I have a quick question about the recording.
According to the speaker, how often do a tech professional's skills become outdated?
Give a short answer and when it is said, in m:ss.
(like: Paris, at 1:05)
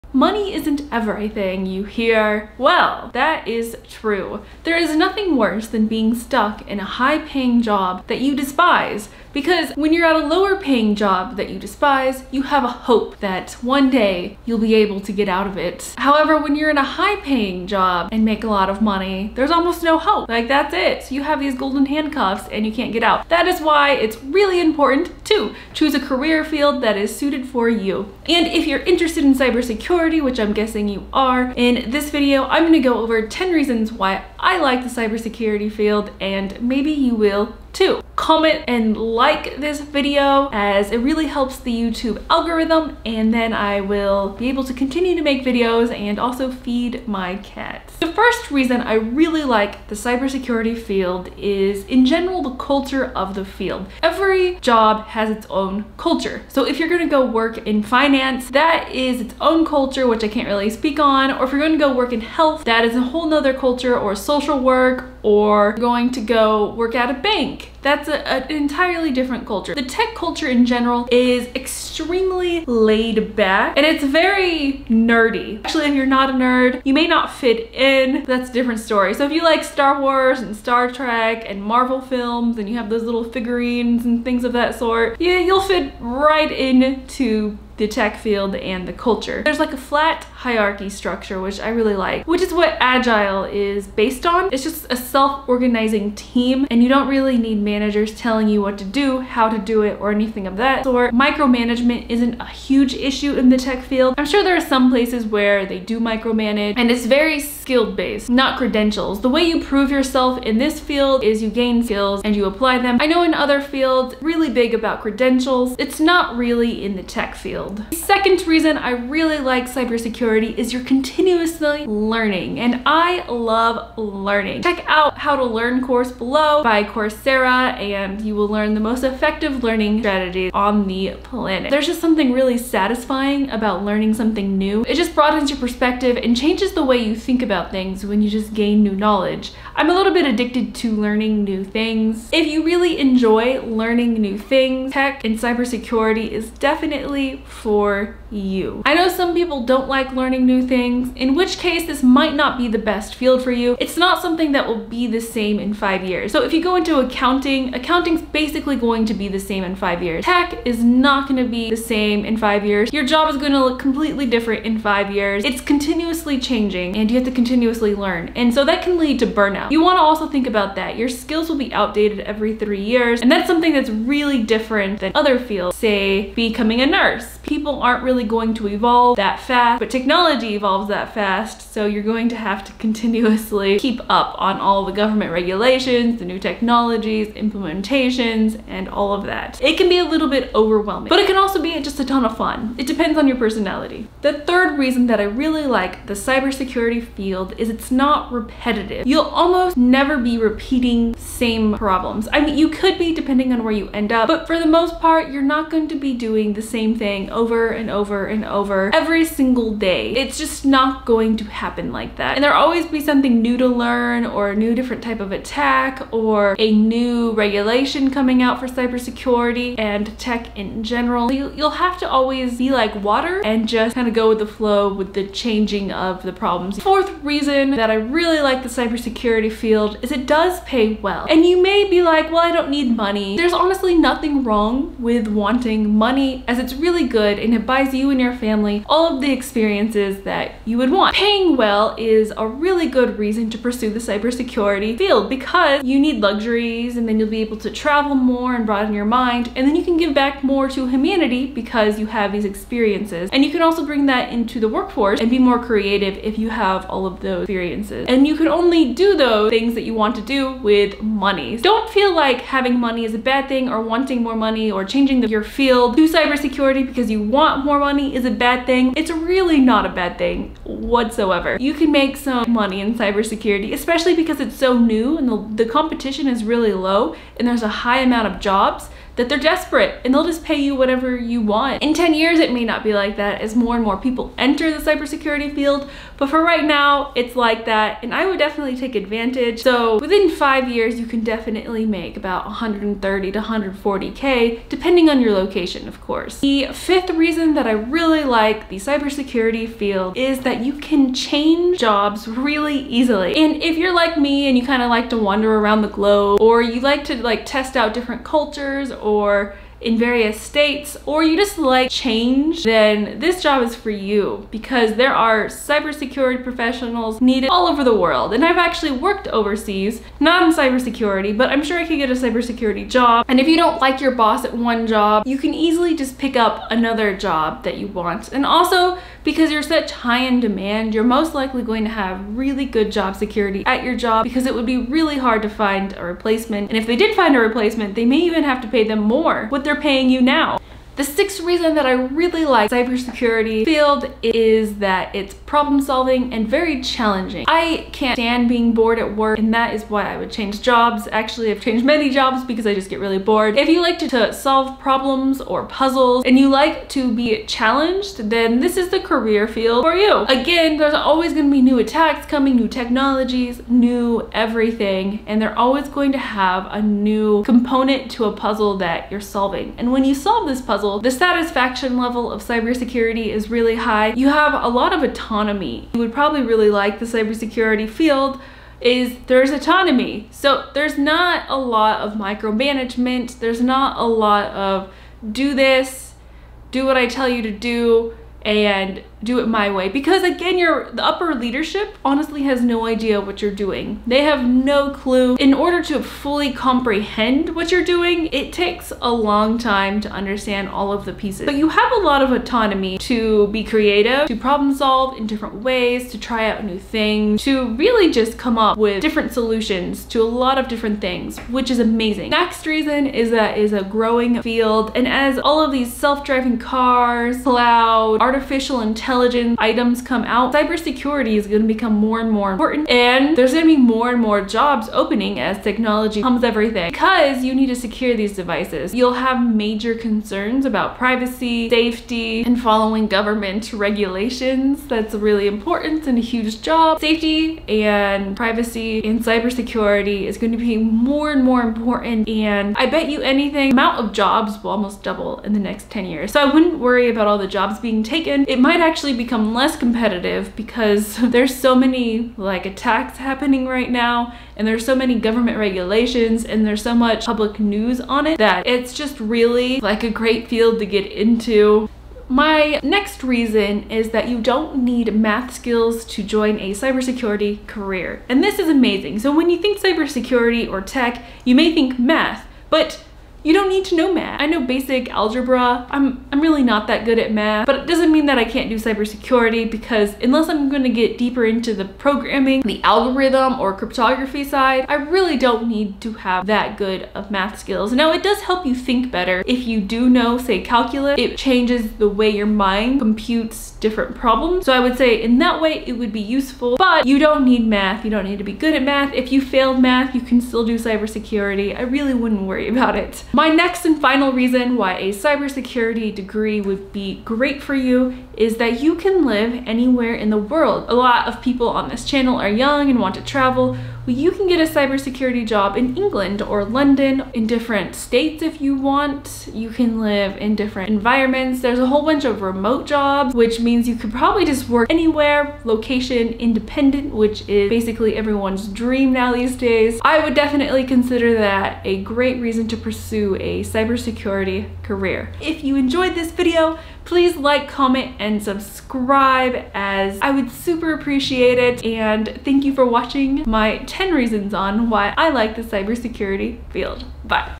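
every 3 years, at 2:52.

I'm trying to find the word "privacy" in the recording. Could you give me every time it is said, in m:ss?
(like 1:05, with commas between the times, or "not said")
7:10, 7:18.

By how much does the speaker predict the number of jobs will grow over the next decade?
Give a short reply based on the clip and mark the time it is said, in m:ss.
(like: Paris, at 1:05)
almost double, at 7:24.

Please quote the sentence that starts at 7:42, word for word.
My next reason is that you don't need math skills to join a cybersecurity career.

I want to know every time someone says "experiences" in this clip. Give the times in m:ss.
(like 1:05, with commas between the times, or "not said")
3:59, 4:12, 4:17.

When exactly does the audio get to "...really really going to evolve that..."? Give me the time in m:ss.
2:58.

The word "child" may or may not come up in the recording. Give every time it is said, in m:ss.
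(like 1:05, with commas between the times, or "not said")
not said.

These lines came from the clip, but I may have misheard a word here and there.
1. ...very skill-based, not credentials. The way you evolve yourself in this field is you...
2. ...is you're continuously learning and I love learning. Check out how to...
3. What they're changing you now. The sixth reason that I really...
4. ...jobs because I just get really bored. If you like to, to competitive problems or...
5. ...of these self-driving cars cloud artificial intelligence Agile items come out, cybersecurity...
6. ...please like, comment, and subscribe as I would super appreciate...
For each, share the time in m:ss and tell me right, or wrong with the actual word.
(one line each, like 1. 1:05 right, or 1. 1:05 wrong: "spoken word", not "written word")
1. 1:47 wrong: "prove", not "evolve"
2. 2:00 right
3. 5:39 wrong: "paying", not "changing"
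4. 5:52 wrong: "solve", not "competitive"
5. 6:55 wrong: "Intelligent", not "Agile"
6. 8:57 right.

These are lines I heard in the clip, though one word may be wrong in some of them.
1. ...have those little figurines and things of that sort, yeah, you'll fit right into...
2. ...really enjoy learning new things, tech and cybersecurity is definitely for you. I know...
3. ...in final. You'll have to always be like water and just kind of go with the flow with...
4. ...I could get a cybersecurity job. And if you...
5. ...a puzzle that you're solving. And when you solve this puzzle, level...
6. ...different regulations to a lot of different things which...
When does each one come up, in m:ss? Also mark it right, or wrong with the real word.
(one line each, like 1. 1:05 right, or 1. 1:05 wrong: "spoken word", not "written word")
1. 1:22 right
2. 2:22 right
3. 3:40 wrong: "general", not "final"
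4. 5:21 right
5. 6:08 right
6. 6:49 wrong: "solutions", not "regulations".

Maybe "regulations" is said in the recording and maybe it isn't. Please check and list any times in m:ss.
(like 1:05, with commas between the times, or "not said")
3:05, 3:37, 7:13, 7:35.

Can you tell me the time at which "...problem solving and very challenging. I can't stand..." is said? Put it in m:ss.
5:45.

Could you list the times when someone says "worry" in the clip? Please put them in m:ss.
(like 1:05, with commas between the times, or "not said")
7:26, 8:22.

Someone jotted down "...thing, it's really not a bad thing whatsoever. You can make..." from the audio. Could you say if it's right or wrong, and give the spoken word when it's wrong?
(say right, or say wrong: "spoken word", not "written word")
right.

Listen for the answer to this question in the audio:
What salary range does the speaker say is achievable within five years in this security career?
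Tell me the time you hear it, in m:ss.
4:52.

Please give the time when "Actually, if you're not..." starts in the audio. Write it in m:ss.
1:15.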